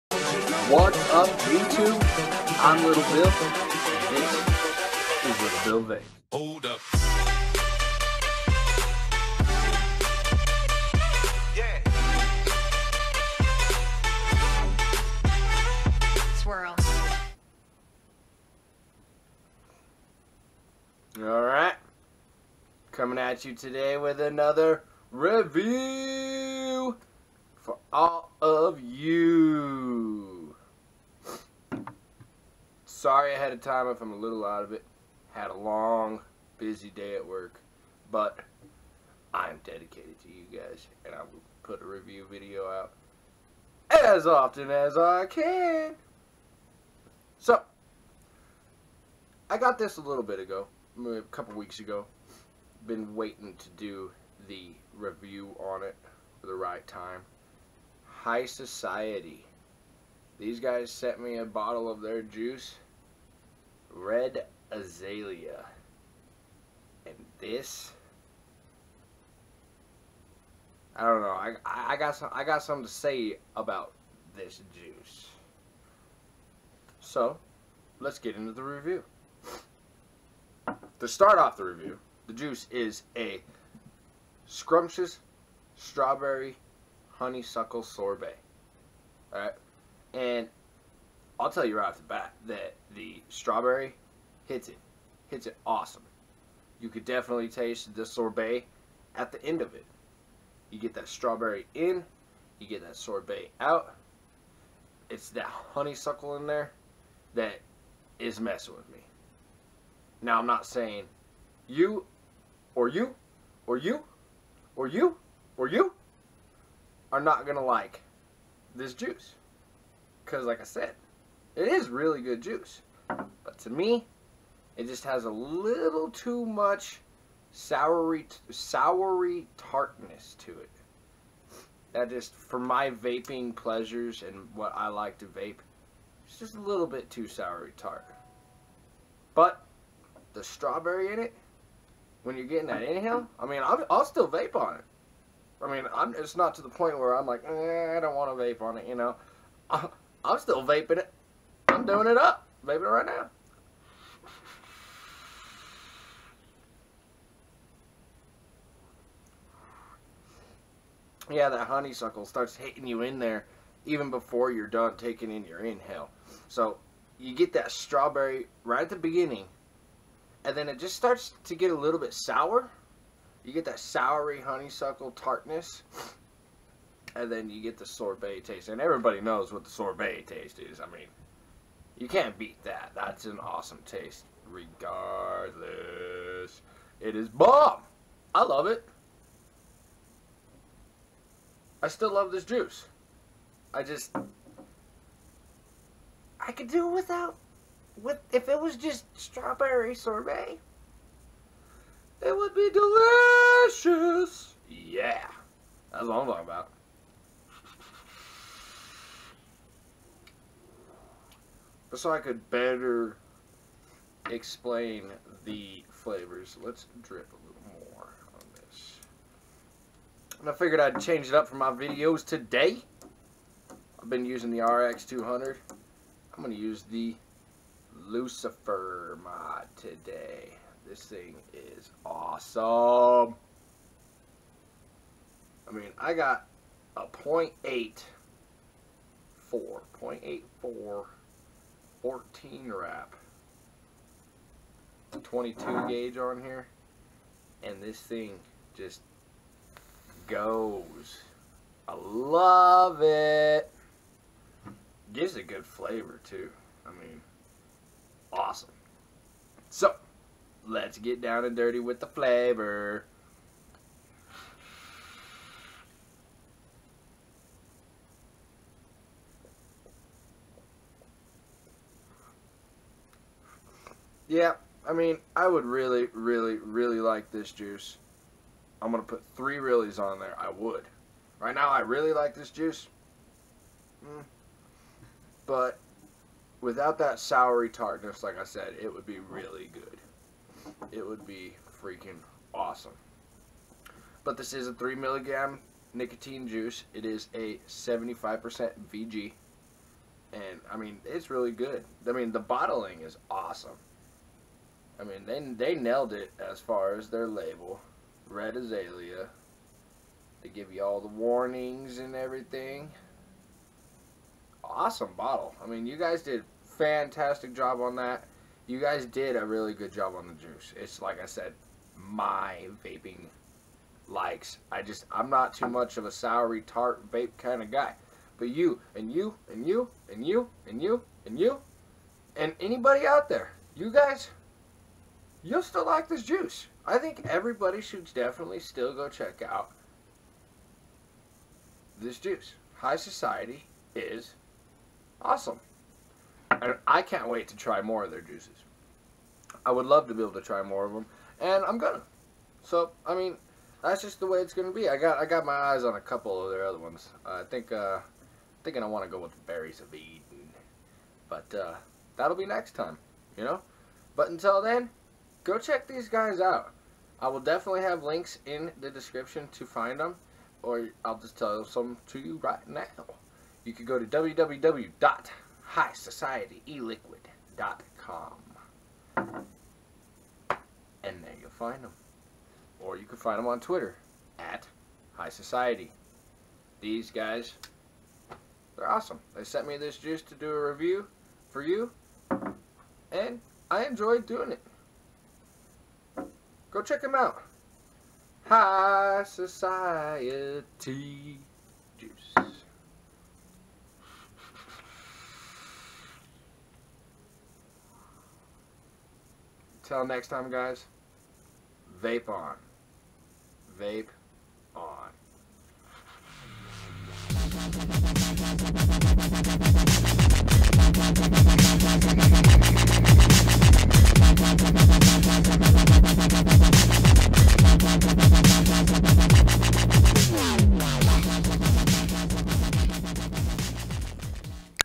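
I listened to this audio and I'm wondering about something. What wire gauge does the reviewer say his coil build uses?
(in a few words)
22 gauge.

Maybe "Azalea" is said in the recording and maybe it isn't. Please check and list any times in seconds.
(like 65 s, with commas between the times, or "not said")
64 s, 308 s.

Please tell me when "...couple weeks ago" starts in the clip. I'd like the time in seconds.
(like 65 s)
51 s.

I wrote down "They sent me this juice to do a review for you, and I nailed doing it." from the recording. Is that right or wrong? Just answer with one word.
wrong.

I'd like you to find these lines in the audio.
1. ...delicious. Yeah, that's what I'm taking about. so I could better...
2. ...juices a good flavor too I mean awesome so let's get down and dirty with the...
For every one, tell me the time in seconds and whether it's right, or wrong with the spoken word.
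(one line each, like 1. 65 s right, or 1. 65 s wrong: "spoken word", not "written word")
1. 203 s wrong: "talking", not "taking"
2. 255 s wrong: "gives", not "juices".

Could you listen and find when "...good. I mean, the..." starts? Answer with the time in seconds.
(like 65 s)
301 s.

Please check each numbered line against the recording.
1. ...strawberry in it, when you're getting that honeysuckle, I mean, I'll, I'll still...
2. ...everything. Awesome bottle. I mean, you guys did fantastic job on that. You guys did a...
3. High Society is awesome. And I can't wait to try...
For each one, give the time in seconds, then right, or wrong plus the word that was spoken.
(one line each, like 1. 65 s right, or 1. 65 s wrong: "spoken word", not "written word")
1. 140 s wrong: "inhale", not "honeysuckle"
2. 312 s right
3. 342 s right.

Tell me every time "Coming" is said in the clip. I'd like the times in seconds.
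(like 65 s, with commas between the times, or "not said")
22 s.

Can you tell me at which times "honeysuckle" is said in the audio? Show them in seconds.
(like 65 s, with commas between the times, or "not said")
87 s, 105 s, 161 s, 174 s.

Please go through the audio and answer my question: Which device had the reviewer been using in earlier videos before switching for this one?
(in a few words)
RX 200.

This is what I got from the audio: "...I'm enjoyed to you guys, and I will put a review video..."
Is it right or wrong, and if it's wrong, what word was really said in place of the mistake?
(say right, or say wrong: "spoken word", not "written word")
wrong: "dedicated", not "enjoyed".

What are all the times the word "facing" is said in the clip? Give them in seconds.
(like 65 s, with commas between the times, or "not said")
not said.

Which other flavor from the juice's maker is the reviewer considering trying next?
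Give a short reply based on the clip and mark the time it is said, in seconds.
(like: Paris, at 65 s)
Berries of Eden, at 359 s.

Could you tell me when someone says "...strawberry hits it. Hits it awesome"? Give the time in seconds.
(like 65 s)
93 s.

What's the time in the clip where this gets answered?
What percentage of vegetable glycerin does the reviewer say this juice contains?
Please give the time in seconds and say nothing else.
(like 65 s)
297 s.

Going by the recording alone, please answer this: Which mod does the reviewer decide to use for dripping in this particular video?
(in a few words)
Lucifer mod.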